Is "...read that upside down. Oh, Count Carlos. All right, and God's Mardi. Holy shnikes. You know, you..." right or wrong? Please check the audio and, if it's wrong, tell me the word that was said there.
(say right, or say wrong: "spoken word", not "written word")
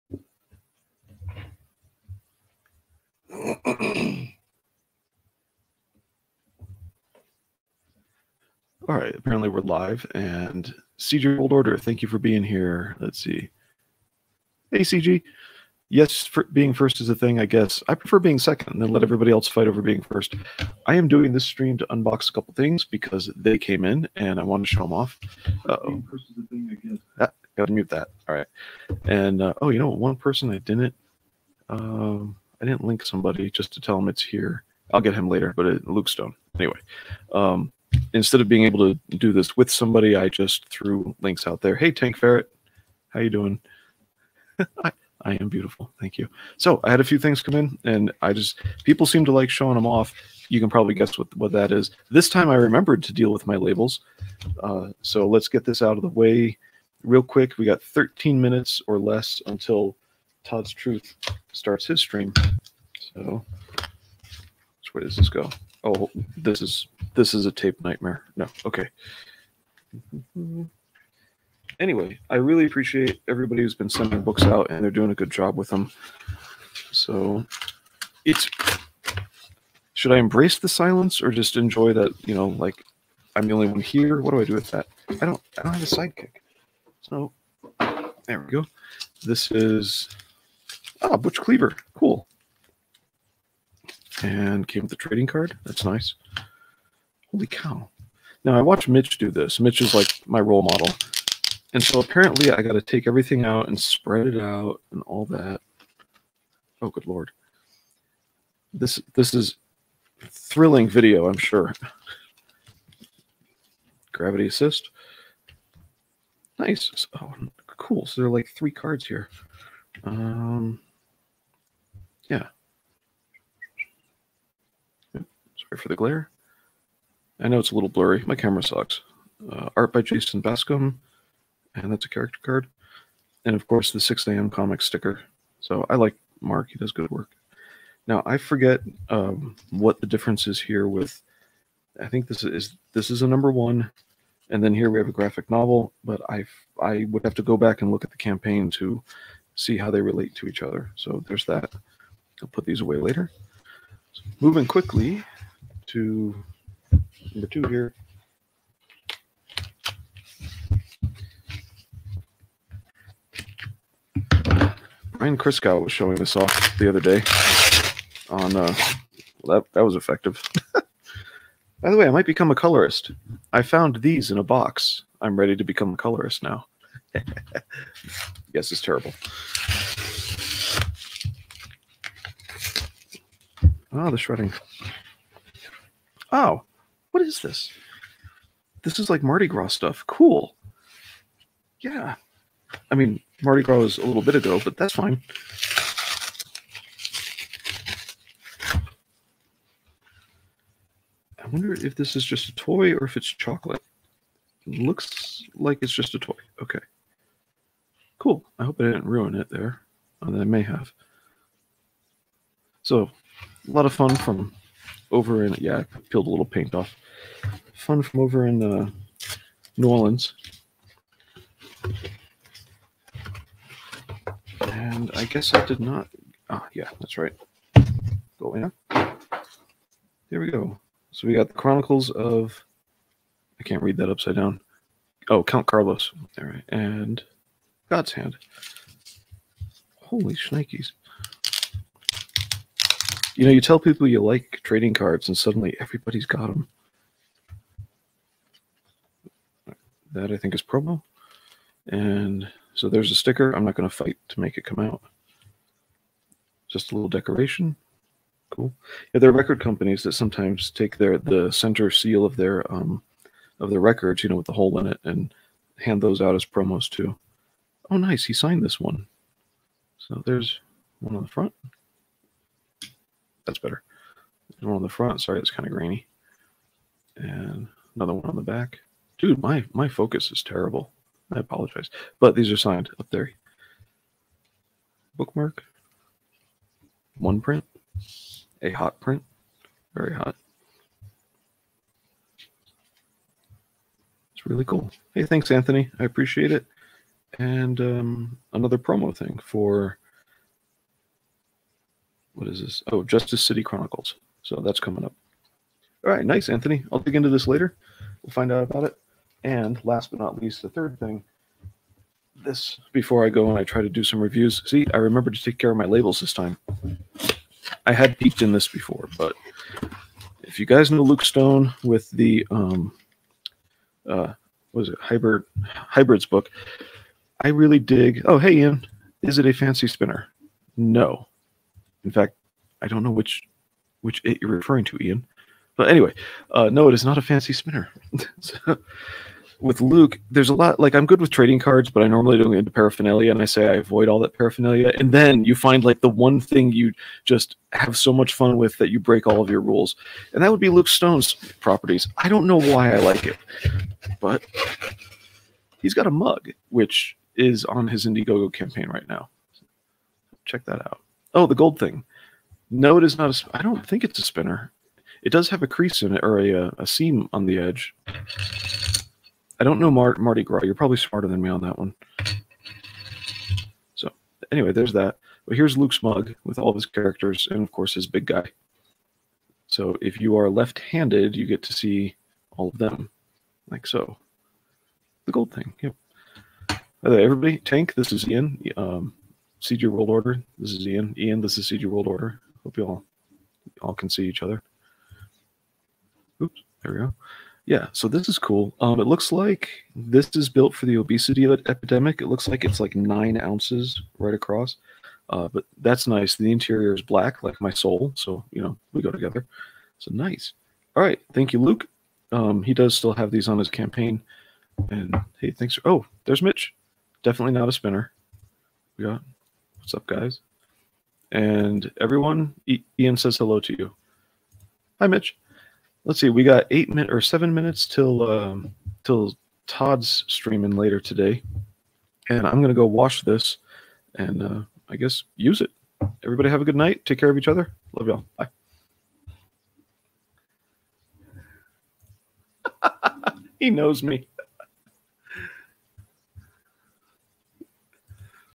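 wrong: "Hand", not "Mardi".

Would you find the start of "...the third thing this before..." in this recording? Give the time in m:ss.
5:10.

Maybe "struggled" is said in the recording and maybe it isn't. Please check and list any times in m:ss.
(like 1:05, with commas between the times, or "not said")
not said.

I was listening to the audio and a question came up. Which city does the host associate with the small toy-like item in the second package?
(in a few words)
New Orleans.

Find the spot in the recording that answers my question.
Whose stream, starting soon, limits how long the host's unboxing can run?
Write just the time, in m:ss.
1:00.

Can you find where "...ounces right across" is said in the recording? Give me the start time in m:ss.
6:43.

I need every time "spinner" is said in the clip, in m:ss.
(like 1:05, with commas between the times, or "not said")
5:29, 5:37, 6:04, 6:57.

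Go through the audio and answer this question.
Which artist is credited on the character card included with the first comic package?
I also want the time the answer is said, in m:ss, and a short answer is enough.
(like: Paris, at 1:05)
Jason Bascom, at 2:10.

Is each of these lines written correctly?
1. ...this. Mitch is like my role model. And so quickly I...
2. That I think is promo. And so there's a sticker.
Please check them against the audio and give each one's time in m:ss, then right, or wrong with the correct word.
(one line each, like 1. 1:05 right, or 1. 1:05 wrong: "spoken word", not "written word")
1. 1:39 wrong: "apparently", not "quickly"
2. 4:10 right.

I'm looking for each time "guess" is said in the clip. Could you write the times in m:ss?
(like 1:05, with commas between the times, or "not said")
0:17, 0:50, 3:45, 7:14.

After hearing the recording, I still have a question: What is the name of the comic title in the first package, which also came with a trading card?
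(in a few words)
Butch Cleaver.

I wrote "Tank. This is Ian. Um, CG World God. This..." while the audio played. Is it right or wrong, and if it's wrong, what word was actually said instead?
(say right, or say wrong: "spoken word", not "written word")
wrong: "Order", not "God".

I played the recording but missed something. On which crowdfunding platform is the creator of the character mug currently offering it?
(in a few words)
Indiegogo.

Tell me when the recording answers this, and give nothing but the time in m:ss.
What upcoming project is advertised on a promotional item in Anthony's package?
5:03.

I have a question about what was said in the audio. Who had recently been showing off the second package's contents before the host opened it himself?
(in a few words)
Brian Criscow.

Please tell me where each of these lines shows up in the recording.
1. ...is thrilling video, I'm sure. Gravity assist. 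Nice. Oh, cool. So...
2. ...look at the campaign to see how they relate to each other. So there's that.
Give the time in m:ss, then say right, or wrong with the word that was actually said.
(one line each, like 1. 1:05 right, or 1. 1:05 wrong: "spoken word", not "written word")
1. 1:49 right
2. 2:27 right.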